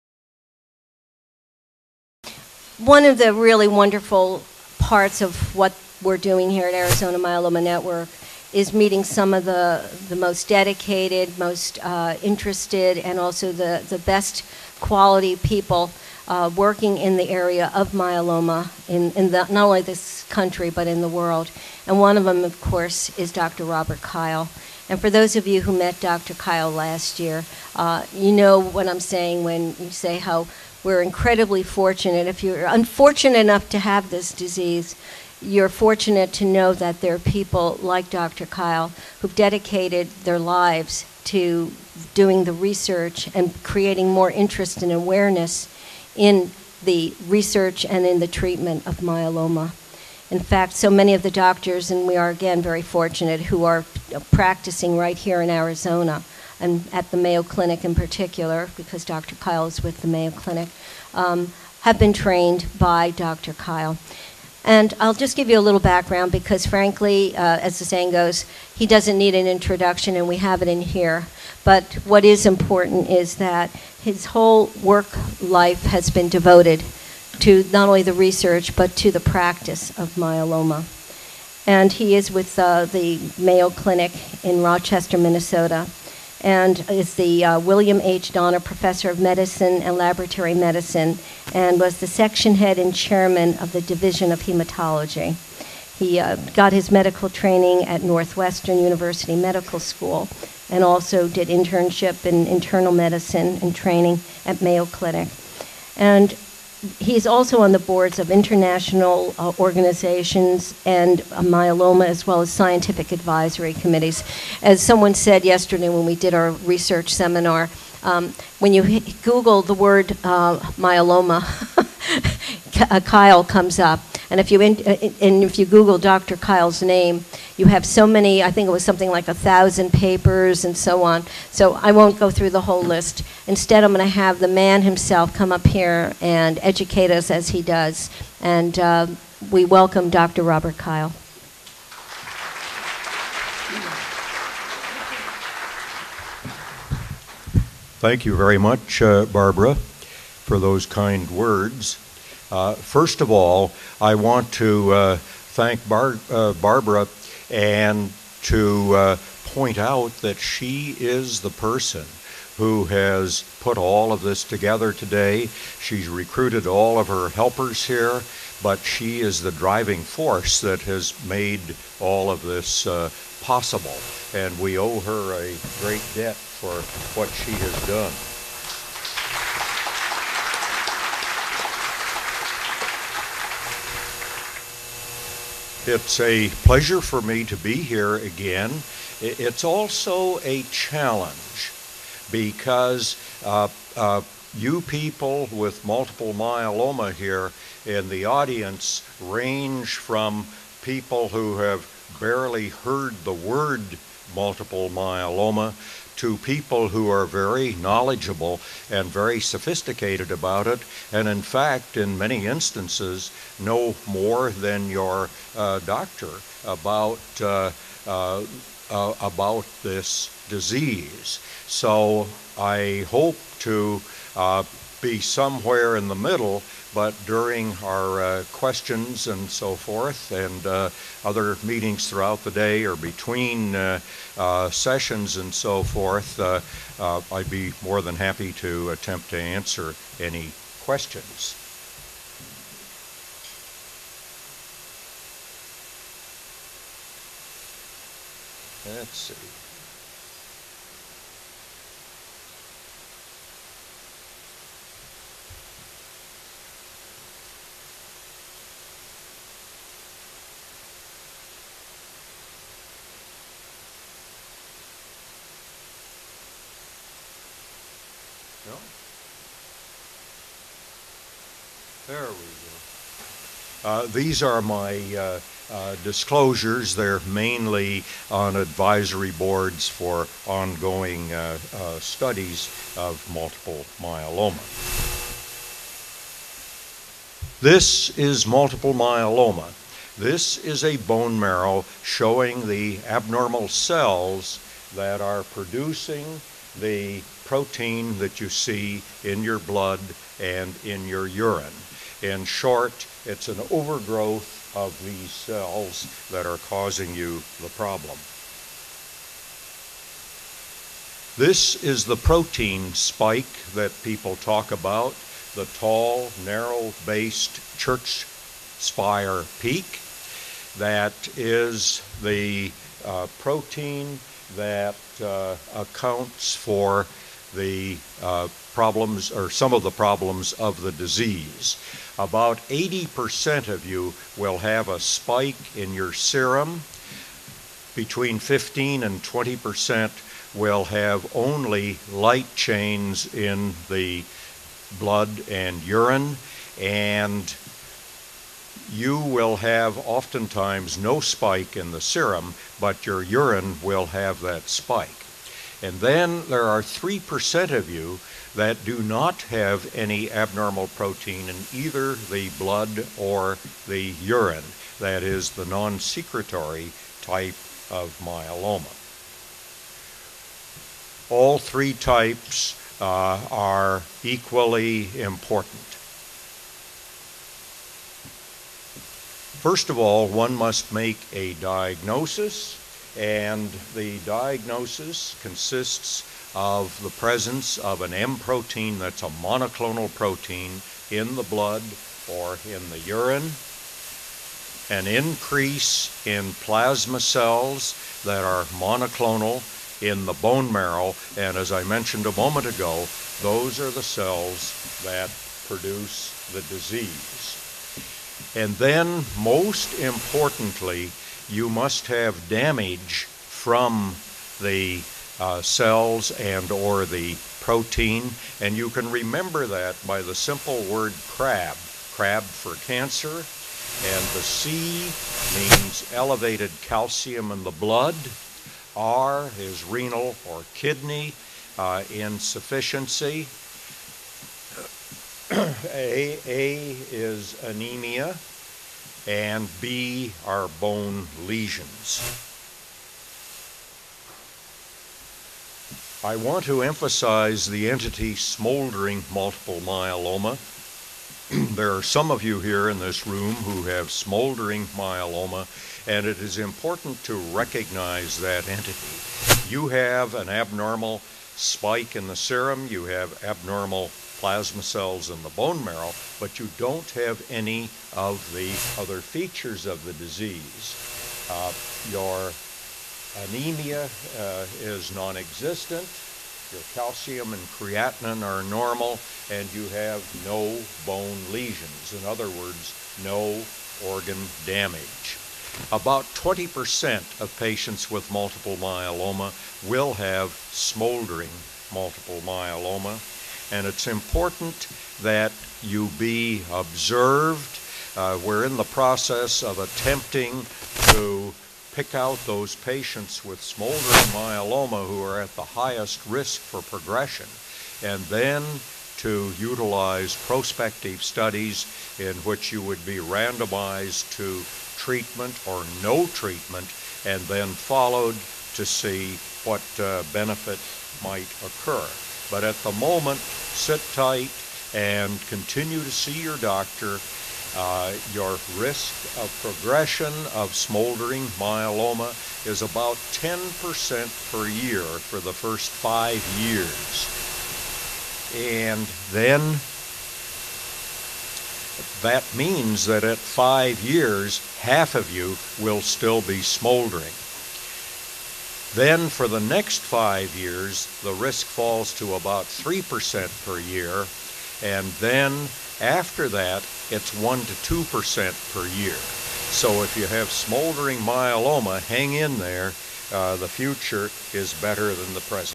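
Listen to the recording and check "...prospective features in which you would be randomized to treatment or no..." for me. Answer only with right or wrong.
wrong.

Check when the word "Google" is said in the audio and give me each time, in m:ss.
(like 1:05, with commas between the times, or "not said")
1:59, 2:05.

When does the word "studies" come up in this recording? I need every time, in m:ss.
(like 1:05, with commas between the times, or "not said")
4:41, 8:31.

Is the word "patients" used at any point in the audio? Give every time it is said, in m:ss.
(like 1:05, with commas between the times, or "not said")
8:07, 8:22.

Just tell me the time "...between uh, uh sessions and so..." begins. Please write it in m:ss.
3:52.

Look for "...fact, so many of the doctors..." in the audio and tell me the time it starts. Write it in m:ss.
0:50.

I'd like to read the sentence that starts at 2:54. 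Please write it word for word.
And we owe her a great debt for what she has done.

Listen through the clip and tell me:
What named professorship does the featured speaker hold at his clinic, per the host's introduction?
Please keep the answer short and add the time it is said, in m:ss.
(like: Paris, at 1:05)
William H. Donner Professor, at 1:27.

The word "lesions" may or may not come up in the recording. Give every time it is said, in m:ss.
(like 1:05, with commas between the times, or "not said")
7:21, 8:01.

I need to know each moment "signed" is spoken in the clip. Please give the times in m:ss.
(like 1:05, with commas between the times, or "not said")
not said.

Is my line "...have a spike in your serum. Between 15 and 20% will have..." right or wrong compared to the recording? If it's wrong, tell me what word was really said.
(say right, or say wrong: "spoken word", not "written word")
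right.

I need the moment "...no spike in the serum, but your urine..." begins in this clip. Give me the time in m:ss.
5:50.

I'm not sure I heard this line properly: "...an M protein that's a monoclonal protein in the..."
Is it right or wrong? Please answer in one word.
right.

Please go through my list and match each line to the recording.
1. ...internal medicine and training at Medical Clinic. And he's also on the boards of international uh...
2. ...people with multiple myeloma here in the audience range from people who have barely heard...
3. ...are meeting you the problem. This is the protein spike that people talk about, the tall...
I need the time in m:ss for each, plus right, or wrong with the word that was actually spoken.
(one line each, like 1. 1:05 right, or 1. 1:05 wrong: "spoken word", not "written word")
1. 1:42 wrong: "Mayo", not "Medical"
2. 3:14 right
3. 5:06 wrong: "causing", not "meeting".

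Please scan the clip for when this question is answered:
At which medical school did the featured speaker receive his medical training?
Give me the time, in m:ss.
1:38.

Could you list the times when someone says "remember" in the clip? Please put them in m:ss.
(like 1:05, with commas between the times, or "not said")
6:59.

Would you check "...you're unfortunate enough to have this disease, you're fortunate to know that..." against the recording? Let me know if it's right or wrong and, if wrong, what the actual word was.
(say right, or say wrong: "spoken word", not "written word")
right.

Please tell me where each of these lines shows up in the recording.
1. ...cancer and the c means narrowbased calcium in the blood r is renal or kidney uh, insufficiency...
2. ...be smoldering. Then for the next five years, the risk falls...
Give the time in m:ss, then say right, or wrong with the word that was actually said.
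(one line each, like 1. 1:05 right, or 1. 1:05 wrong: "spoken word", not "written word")
1. 7:02 wrong: "elevated", not "narrowbased"
2. 9:06 right.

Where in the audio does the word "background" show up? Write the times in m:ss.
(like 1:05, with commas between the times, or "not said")
1:05.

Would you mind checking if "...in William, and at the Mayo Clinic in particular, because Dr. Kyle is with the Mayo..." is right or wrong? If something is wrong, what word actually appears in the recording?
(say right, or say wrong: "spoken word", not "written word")
wrong: "Arizona", not "William".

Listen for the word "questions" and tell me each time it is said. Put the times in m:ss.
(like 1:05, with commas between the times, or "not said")
3:48, 4:00.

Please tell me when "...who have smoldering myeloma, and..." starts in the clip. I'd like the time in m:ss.
7:33.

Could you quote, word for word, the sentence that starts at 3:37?
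Uh, uh, uh about this disease.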